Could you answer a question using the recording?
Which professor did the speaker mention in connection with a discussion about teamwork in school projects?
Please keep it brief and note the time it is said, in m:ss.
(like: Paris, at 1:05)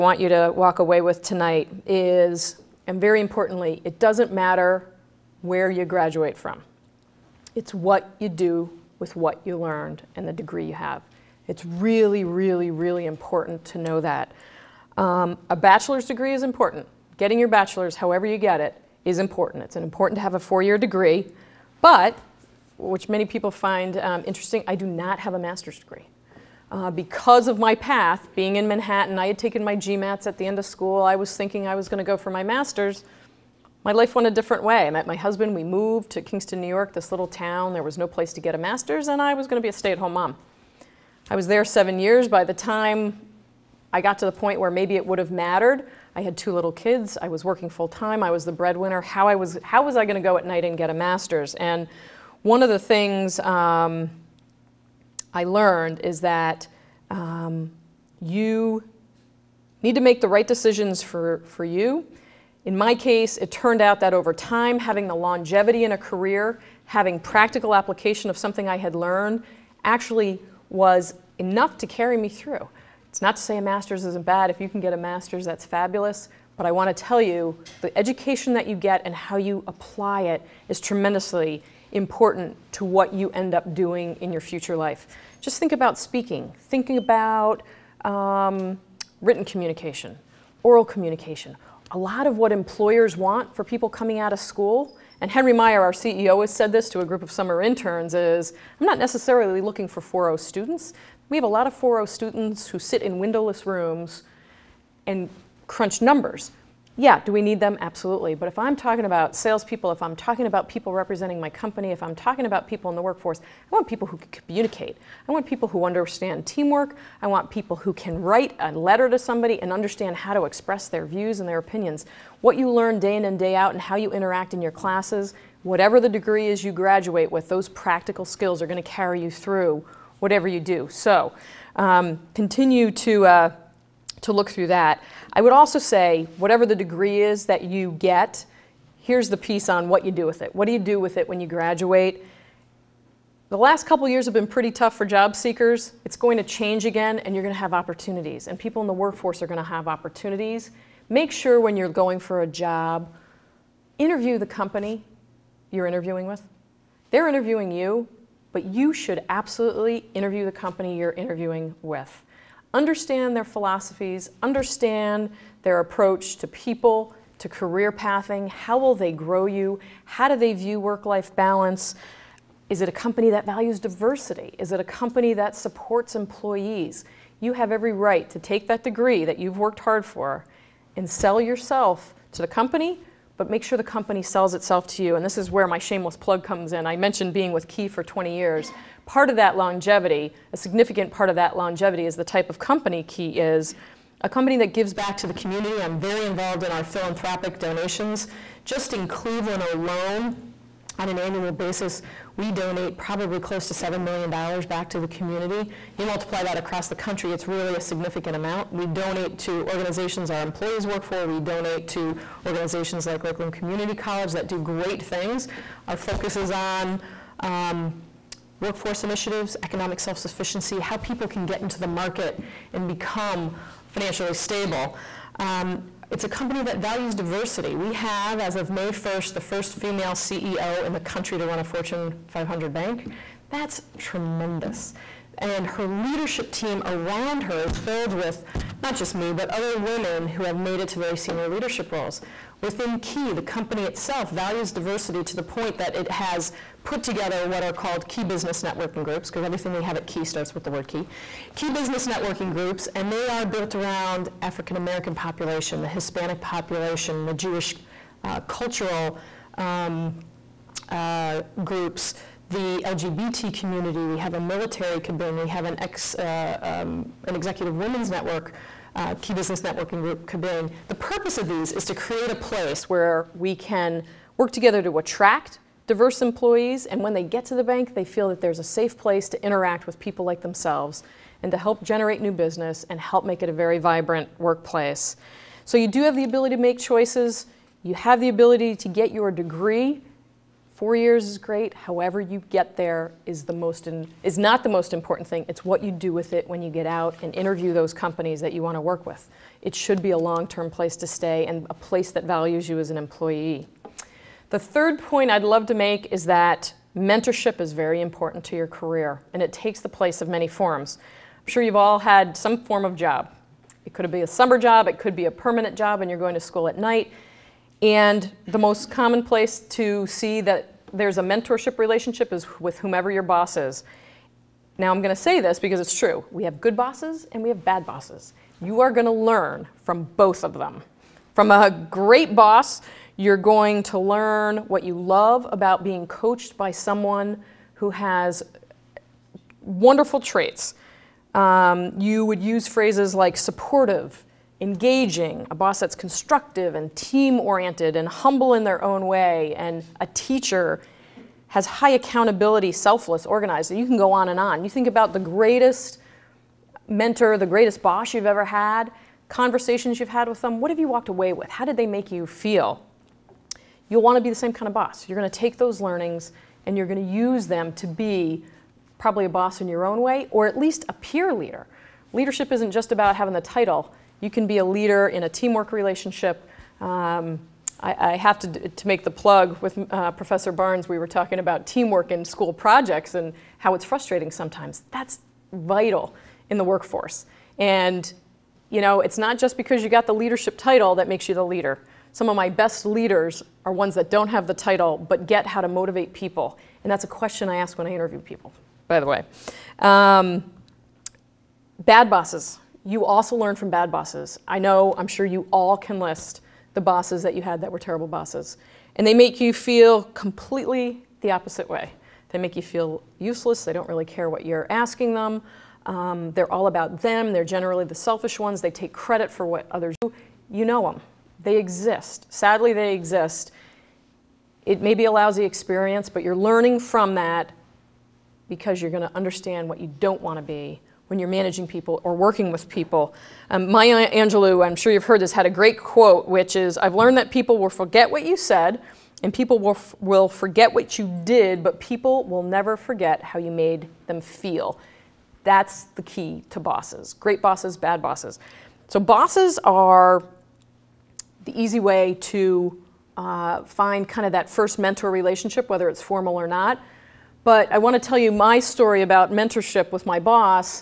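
Professor Barnes, at 6:20.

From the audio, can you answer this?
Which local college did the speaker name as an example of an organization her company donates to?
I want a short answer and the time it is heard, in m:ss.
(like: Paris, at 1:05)
Lakeland Community College, at 3:33.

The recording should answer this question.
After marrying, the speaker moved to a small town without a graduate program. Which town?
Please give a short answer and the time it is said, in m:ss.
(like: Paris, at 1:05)
Kingston, New York, at 0:36.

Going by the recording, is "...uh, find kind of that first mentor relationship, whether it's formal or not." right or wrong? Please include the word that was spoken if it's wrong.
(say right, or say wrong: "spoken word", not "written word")
right.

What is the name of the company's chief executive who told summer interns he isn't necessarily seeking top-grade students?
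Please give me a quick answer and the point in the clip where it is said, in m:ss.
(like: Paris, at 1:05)
Henry Meyer, at 1:35.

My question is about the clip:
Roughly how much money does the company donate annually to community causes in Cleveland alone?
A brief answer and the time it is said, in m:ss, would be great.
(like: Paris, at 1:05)
$7 million, at 3:23.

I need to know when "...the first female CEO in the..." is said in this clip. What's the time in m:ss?
3:49.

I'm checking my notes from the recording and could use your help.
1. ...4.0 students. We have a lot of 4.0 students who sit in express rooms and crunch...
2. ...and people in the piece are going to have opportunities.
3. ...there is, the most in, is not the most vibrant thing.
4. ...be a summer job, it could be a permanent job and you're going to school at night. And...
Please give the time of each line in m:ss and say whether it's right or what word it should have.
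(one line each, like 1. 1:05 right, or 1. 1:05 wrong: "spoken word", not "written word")
1. 1:40 wrong: "windowless", not "express"
2. 2:28 wrong: "workforce", not "piece"
3. 4:52 wrong: "important", not "vibrant"
4. 5:14 right.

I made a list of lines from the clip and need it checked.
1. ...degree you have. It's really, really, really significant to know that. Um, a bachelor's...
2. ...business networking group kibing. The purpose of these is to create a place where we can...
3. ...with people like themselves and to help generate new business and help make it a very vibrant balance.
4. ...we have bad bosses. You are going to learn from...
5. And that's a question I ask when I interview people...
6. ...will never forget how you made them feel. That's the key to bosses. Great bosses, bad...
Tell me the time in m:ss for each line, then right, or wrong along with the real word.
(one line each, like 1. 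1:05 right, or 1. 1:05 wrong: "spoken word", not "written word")
1. 0:10 wrong: "important", not "significant"
2. 4:29 right
3. 4:39 wrong: "workplace", not "balance"
4. 5:27 right
5. 6:36 right
6. 7:22 right.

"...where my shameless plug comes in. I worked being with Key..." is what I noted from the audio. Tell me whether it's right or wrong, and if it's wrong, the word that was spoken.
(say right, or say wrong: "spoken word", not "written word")
wrong: "mentioned", not "worked".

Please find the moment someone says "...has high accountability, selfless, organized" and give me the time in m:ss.
5:51.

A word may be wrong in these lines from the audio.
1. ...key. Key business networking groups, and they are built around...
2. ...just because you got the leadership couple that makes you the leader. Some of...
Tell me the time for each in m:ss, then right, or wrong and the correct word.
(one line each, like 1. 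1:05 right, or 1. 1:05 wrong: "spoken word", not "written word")
1. 4:10 right
2. 6:29 wrong: "title", not "couple".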